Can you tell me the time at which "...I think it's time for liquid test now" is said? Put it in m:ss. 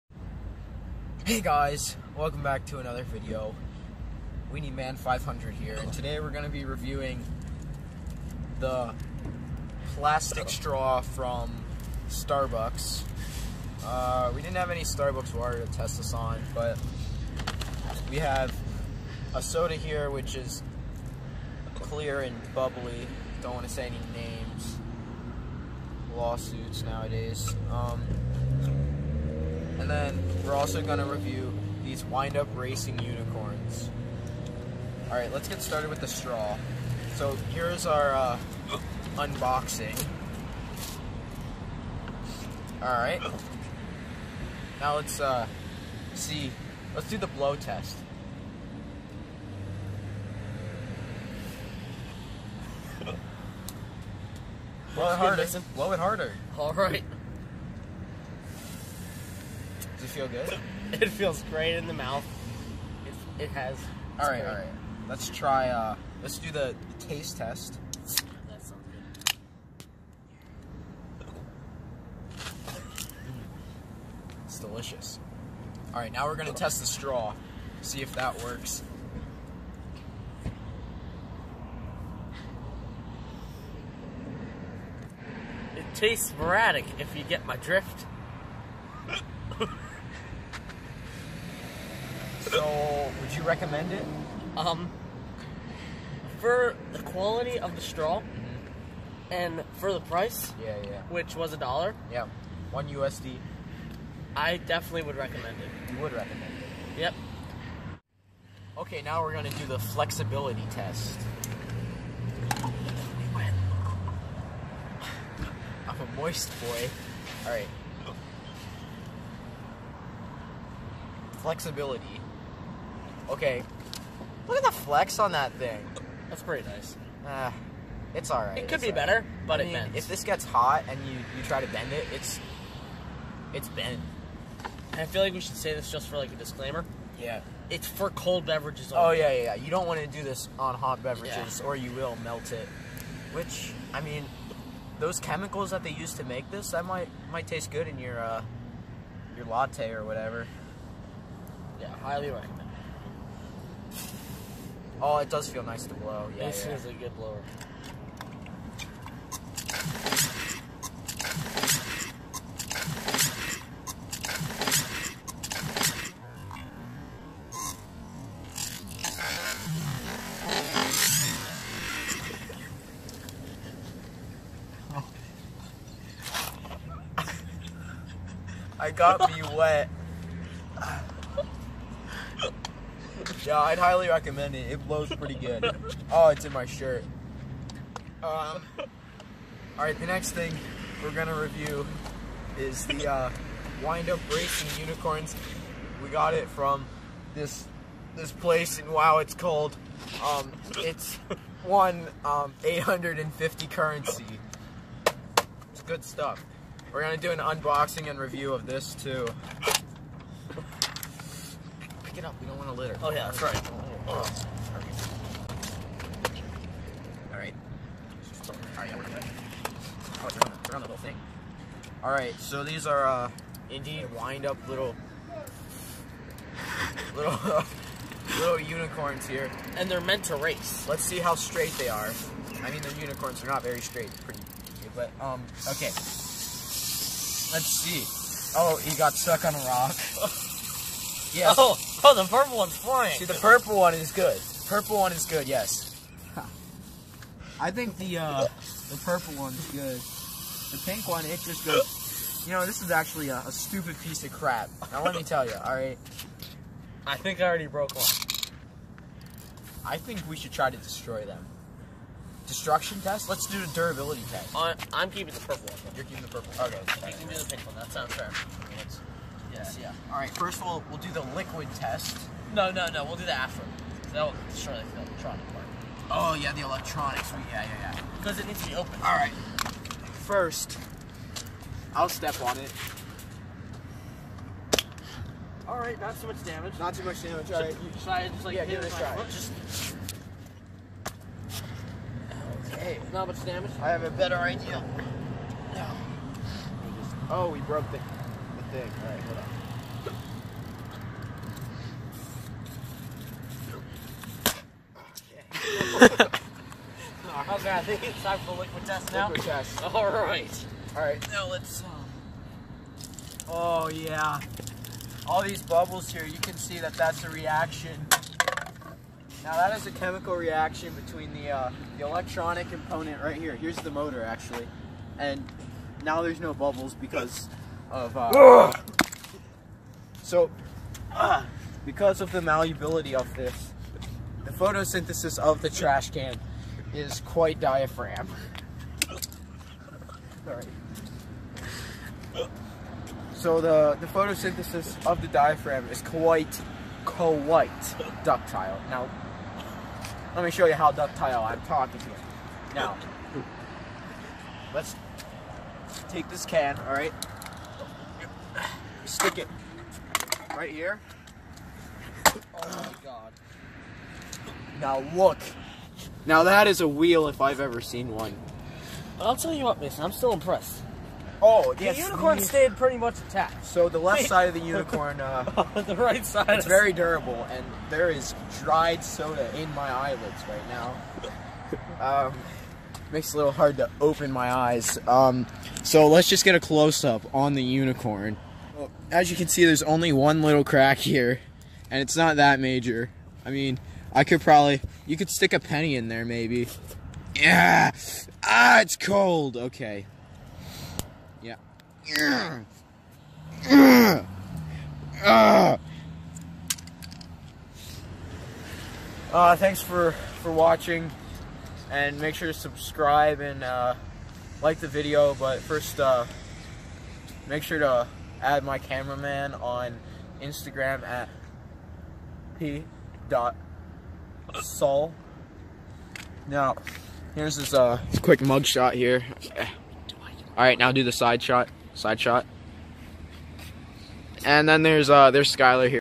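5:07.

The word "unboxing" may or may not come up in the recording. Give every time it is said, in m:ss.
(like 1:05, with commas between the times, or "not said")
0:39, 3:27.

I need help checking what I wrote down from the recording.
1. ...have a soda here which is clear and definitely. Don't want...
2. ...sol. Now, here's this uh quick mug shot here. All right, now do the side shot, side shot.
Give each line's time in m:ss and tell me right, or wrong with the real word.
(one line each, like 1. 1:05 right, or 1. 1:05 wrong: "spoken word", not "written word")
1. 0:18 wrong: "bubbly", not "definitely"
2. 7:04 right.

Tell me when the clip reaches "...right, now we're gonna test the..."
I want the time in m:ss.
1:15.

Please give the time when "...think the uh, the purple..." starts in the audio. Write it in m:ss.
4:07.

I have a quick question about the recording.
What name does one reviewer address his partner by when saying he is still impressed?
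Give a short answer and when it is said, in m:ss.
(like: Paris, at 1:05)
Mason, at 6:09.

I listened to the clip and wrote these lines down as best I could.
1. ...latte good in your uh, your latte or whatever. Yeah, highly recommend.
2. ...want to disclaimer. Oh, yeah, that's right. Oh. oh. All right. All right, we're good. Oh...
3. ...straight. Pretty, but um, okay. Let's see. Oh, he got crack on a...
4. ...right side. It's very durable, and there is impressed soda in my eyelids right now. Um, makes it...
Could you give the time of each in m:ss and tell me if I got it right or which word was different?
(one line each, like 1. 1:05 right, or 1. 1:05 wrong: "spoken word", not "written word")
1. 2:27 wrong: "taste", not "latte"
2. 3:32 wrong: "litter", not "disclaimer"
3. 3:53 wrong: "stuck", not "crack"
4. 6:15 wrong: "dried", not "impressed".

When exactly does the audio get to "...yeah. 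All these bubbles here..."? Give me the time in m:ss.
5:13.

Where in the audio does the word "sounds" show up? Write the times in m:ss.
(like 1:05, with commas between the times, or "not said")
1:08, 4:27.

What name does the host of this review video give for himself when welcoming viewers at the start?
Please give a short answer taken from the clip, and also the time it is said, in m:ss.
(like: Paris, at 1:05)
WeeneyMan500, at 0:04.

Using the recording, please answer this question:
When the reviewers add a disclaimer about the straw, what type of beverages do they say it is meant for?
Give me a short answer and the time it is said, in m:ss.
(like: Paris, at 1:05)
Cold beverages, at 2:18.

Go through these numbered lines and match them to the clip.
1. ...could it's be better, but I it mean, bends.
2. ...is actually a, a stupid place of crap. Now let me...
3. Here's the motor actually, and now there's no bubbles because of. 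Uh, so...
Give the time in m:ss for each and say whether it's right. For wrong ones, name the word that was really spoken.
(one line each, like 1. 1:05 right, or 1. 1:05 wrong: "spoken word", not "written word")
1. 2:08 right
2. 4:12 wrong: "piece", not "place"
3. 5:23 right.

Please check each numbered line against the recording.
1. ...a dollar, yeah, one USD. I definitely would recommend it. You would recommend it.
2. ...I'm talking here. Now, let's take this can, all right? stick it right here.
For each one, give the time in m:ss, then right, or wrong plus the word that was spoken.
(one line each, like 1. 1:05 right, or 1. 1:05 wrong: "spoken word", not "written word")
1. 1:41 right
2. 5:51 right.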